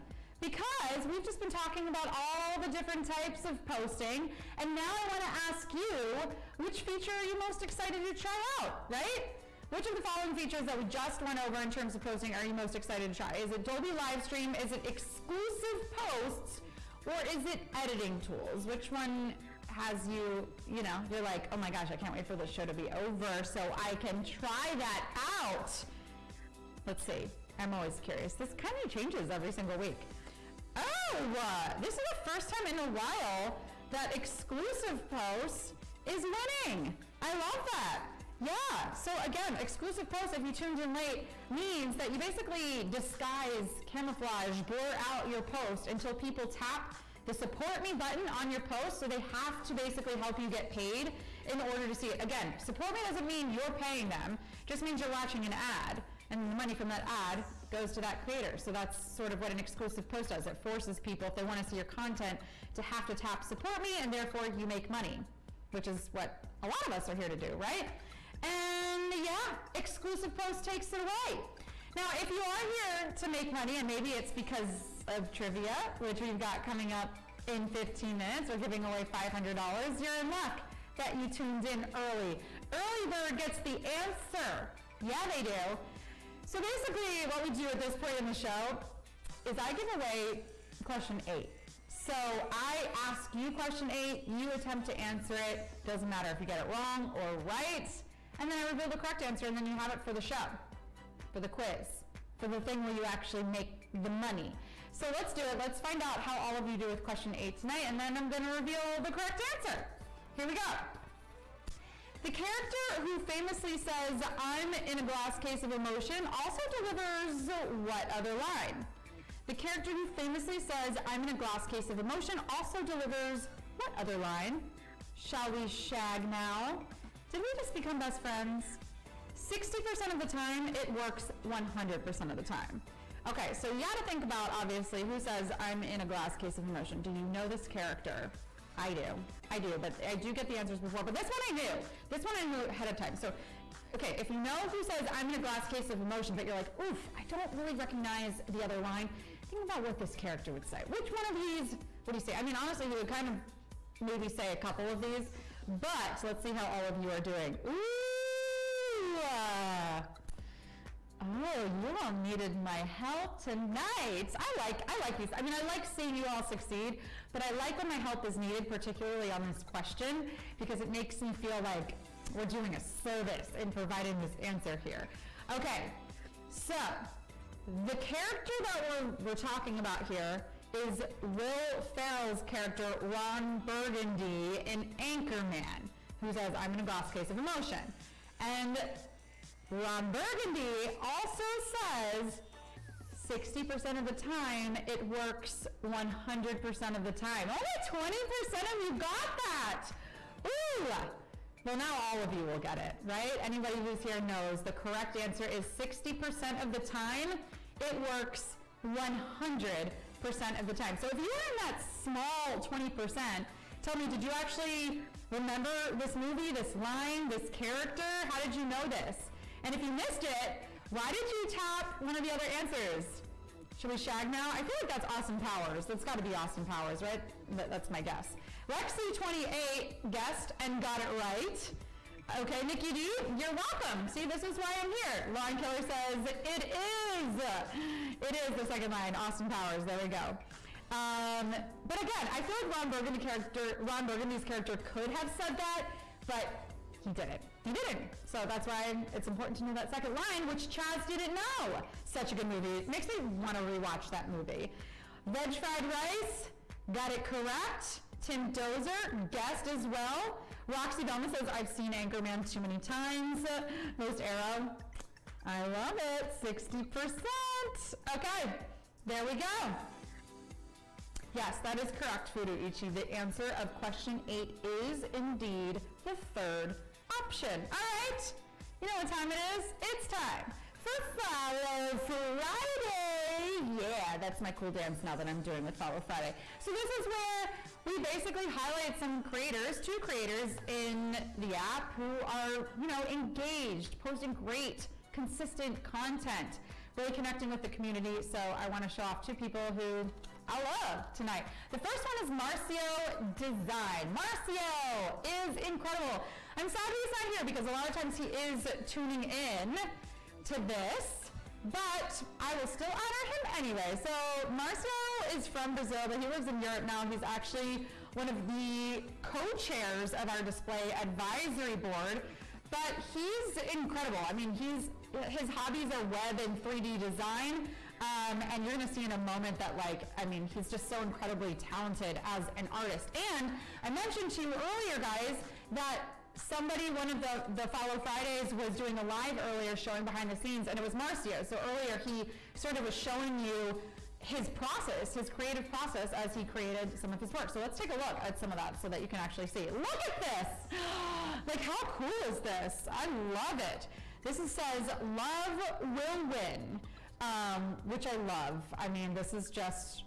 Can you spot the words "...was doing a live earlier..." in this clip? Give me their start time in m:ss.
5:38.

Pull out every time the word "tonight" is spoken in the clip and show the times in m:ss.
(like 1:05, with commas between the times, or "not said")
1:47, 2:43, 5:01.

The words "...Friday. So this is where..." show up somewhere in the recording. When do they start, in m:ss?
4:46.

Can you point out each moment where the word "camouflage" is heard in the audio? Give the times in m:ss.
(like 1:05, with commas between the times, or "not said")
0:43.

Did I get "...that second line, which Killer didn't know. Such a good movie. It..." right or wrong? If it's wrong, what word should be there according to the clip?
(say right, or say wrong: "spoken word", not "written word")
wrong: "Chaz", not "Killer".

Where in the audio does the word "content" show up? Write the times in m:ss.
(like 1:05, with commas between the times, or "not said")
1:01, 4:55.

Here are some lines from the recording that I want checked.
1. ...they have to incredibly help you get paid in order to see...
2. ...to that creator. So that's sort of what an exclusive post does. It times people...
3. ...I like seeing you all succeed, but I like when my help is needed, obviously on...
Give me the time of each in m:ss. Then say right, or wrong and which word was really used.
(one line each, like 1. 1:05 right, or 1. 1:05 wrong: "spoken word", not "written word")
1. 0:49 wrong: "basically", not "incredibly"
2. 0:57 wrong: "forces", not "times"
3. 2:45 wrong: "particularly", not "obviously".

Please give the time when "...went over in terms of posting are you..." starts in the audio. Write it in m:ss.
0:11.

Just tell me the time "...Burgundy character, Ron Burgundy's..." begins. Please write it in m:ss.
4:02.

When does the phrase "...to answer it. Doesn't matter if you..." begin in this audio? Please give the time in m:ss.
1:34.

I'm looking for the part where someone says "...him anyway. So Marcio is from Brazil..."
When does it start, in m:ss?
5:12.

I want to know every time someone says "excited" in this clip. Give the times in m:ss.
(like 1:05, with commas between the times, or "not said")
0:07, 0:12.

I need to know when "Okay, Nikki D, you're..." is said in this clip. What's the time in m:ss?
3:52.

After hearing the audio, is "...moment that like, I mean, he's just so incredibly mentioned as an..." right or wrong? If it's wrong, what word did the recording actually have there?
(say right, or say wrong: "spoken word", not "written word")
wrong: "talented", not "mentioned".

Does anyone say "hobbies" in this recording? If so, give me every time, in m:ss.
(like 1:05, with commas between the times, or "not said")
5:25.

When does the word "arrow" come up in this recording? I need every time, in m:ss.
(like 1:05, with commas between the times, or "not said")
4:24.